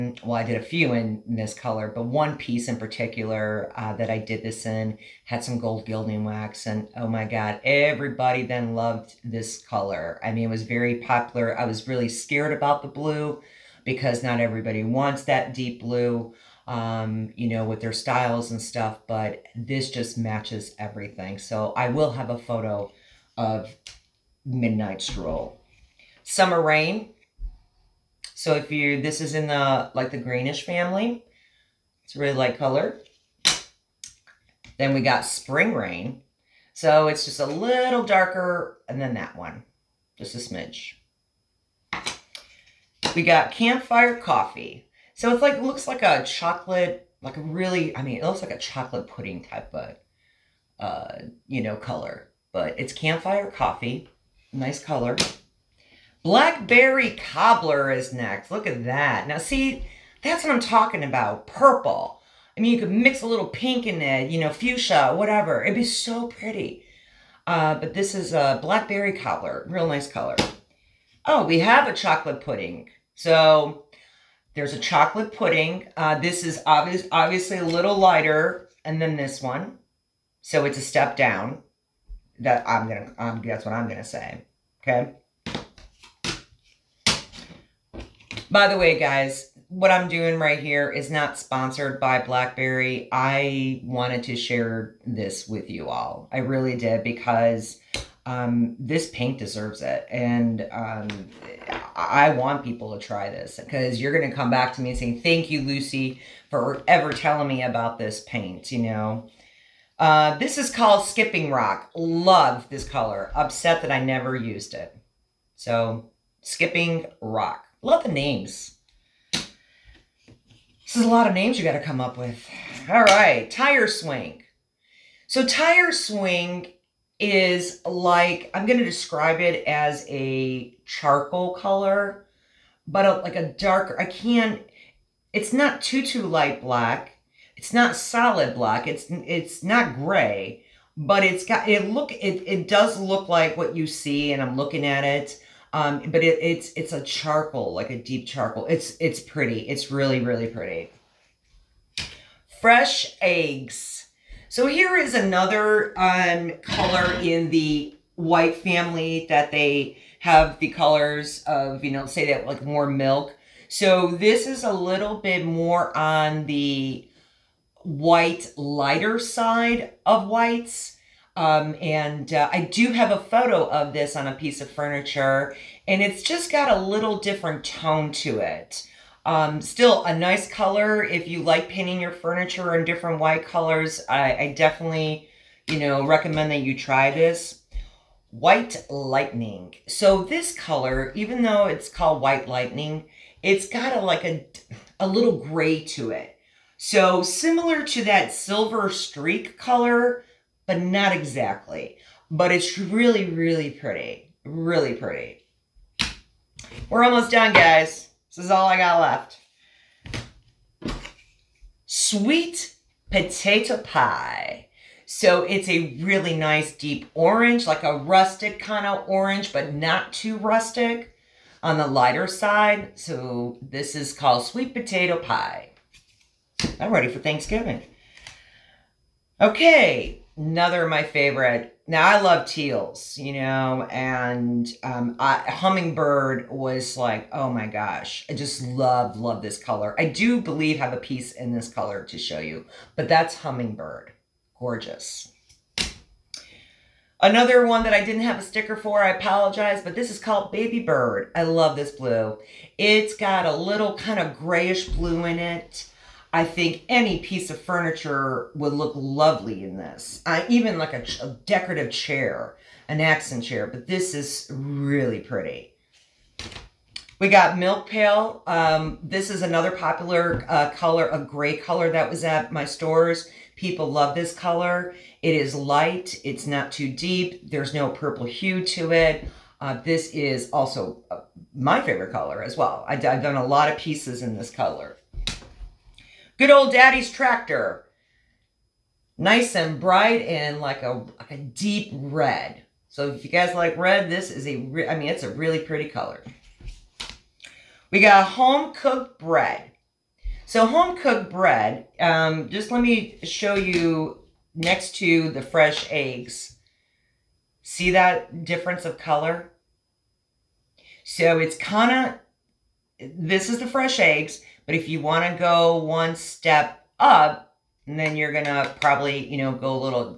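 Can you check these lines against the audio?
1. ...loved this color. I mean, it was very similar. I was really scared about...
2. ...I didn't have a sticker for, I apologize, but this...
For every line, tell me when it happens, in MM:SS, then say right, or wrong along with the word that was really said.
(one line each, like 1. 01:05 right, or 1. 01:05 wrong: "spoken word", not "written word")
1. 00:08 wrong: "popular", not "similar"
2. 04:07 right.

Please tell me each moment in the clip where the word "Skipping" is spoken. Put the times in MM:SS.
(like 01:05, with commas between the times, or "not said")
01:51, 01:56.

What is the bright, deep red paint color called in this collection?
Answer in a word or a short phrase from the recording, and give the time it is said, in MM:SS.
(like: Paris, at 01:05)
Daddy's Tractor, at 04:46.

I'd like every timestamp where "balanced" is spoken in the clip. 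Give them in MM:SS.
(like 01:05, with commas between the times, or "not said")
not said.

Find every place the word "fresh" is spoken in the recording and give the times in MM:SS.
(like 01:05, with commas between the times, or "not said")
02:32, 05:05, 05:13.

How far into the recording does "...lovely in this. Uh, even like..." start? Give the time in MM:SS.
04:18.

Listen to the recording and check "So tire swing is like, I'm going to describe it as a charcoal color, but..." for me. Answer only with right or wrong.
right.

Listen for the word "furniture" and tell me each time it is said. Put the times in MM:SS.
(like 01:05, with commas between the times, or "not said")
02:54, 03:02, 04:17.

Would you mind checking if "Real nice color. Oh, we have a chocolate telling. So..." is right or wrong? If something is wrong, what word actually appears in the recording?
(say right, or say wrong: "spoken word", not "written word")
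wrong: "pudding", not "telling".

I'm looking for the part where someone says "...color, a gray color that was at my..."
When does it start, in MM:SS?
04:30.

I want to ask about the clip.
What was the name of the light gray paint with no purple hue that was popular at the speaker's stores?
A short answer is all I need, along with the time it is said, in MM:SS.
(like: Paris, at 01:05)
Milk Pail, at 04:27.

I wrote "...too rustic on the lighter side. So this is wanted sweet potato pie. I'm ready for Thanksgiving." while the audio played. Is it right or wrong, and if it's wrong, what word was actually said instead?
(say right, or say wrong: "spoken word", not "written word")
wrong: "called", not "wanted".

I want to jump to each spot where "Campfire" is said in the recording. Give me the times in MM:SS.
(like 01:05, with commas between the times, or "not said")
00:43, 00:52.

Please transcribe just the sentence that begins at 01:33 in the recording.
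I wanted to share this with you all.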